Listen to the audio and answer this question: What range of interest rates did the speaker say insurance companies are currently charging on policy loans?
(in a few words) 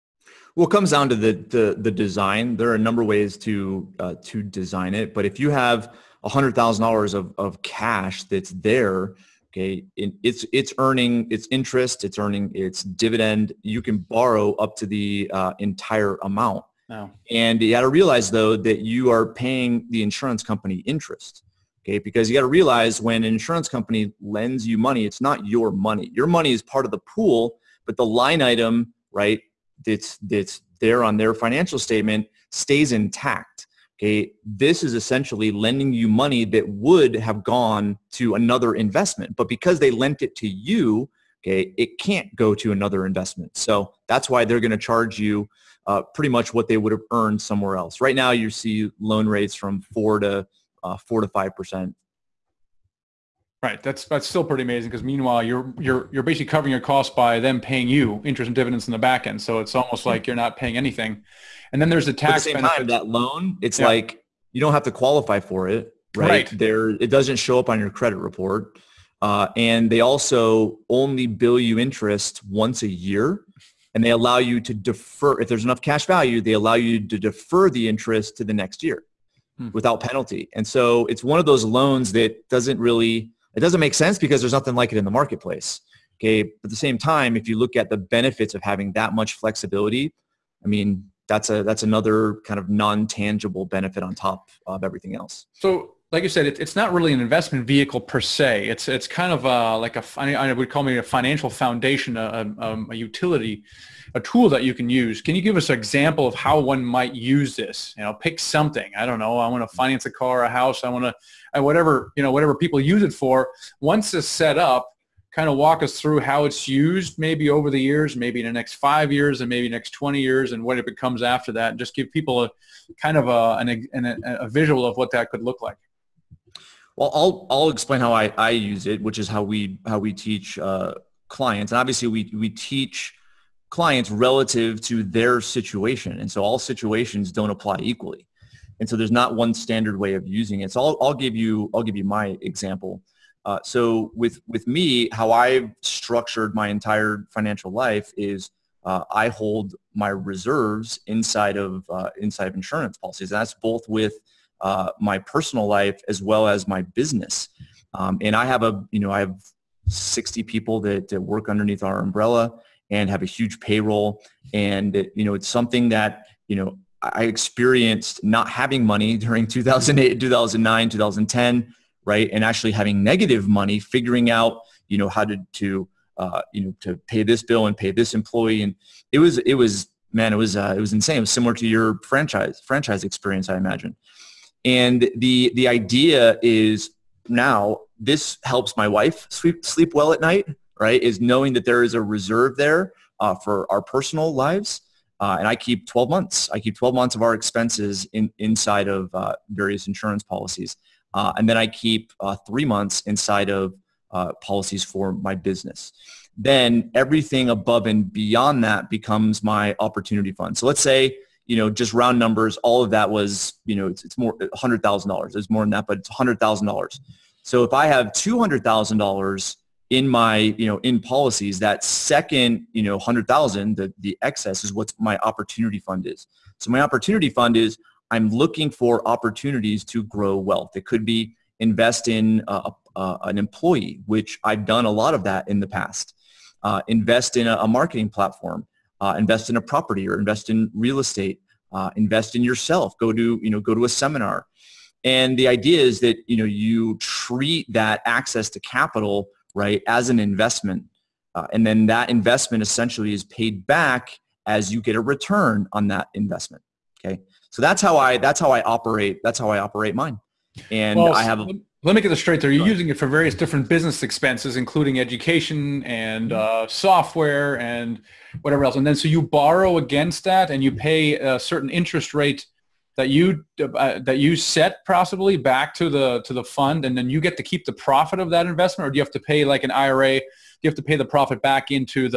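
4 to 5 percent.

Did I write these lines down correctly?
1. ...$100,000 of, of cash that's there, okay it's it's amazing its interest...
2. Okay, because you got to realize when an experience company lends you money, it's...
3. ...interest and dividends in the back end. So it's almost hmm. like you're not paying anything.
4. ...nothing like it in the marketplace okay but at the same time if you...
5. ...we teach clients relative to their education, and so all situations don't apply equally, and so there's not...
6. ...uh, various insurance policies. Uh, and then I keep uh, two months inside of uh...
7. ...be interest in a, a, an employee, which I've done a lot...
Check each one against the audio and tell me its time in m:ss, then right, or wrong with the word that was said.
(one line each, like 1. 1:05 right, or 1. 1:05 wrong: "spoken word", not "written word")
1. 0:06 wrong: "earning", not "amazing"
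2. 0:21 wrong: "insurance", not "experience"
3. 0:58 right
4. 1:24 right
5. 2:12 wrong: "situation", not "education"
6. 3:19 wrong: "three", not "two"
7. 3:51 wrong: "invest", not "interest".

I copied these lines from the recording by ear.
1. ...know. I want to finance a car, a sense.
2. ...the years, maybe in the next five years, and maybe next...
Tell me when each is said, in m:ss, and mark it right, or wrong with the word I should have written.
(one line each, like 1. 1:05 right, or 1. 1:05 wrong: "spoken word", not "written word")
1. 1:49 wrong: "house", not "sense"
2. 1:57 right.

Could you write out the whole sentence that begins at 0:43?
So that's why they're going to charge you uh, pretty much what they would have earned somewhere else.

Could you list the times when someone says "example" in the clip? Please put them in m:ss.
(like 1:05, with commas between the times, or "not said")
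1:45, 2:22.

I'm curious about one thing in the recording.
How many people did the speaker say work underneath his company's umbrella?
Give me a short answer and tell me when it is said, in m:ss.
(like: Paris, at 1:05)
60, at 2:39.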